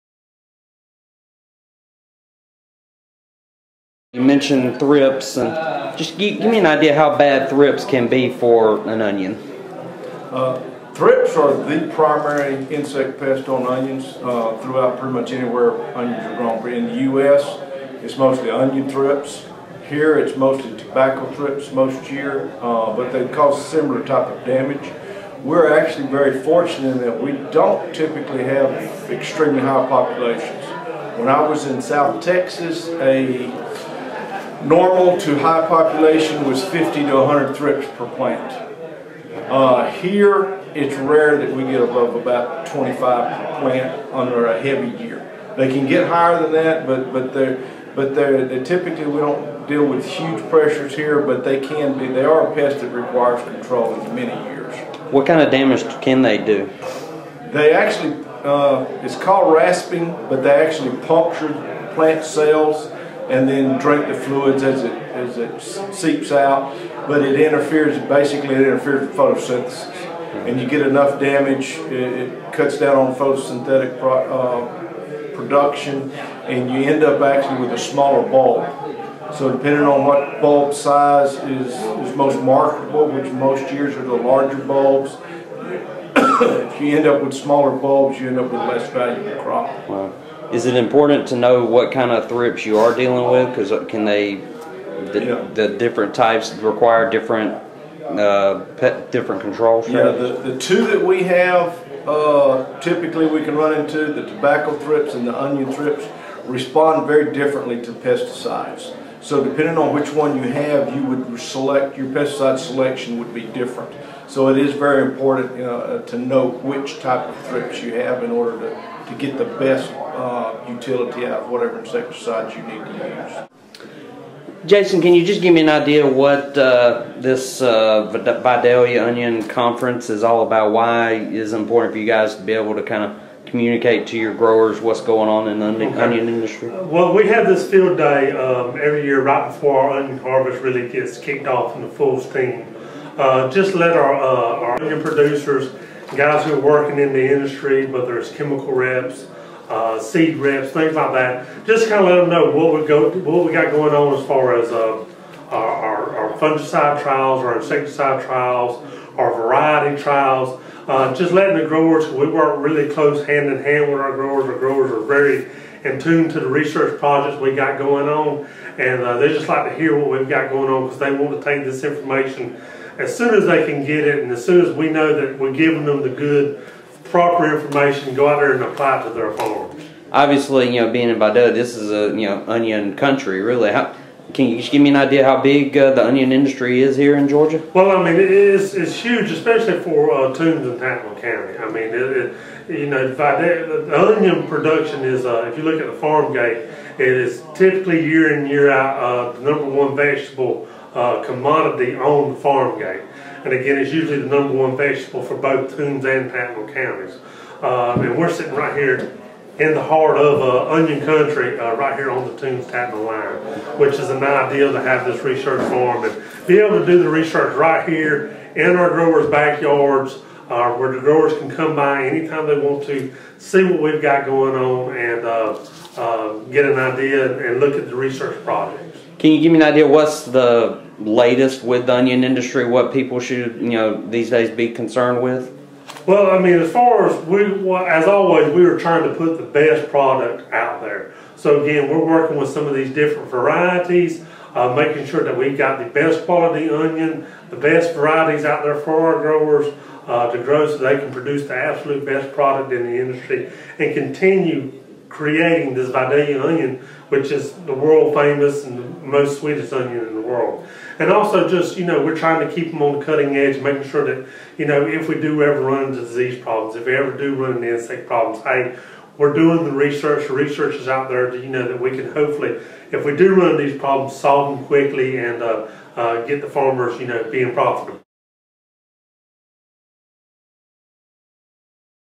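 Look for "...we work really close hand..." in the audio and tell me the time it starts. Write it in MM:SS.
02:42.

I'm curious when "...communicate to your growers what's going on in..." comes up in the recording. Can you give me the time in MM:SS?
02:13.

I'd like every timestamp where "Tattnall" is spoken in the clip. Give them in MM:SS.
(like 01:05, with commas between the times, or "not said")
03:10, 03:26, 03:32.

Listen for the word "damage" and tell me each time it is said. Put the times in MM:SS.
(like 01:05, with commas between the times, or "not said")
00:24, 00:55, 01:11.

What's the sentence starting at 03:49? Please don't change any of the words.
Can you give me an idea what's the latest with the onion industry?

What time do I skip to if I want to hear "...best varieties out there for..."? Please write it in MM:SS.
04:07.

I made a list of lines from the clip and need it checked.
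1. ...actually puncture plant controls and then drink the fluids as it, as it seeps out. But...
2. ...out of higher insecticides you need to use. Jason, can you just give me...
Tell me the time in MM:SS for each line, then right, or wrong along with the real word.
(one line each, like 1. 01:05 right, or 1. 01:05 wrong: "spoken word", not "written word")
1. 01:00 wrong: "cells", not "controls"
2. 02:01 wrong: "whatever", not "higher".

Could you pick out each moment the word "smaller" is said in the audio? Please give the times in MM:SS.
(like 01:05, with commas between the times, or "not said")
01:17, 01:27.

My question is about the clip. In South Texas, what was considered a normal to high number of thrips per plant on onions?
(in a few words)
50 to 100.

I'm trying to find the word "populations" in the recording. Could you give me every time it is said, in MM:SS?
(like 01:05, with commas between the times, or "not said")
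00:29, 00:35.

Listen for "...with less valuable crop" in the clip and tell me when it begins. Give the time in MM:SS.
01:28.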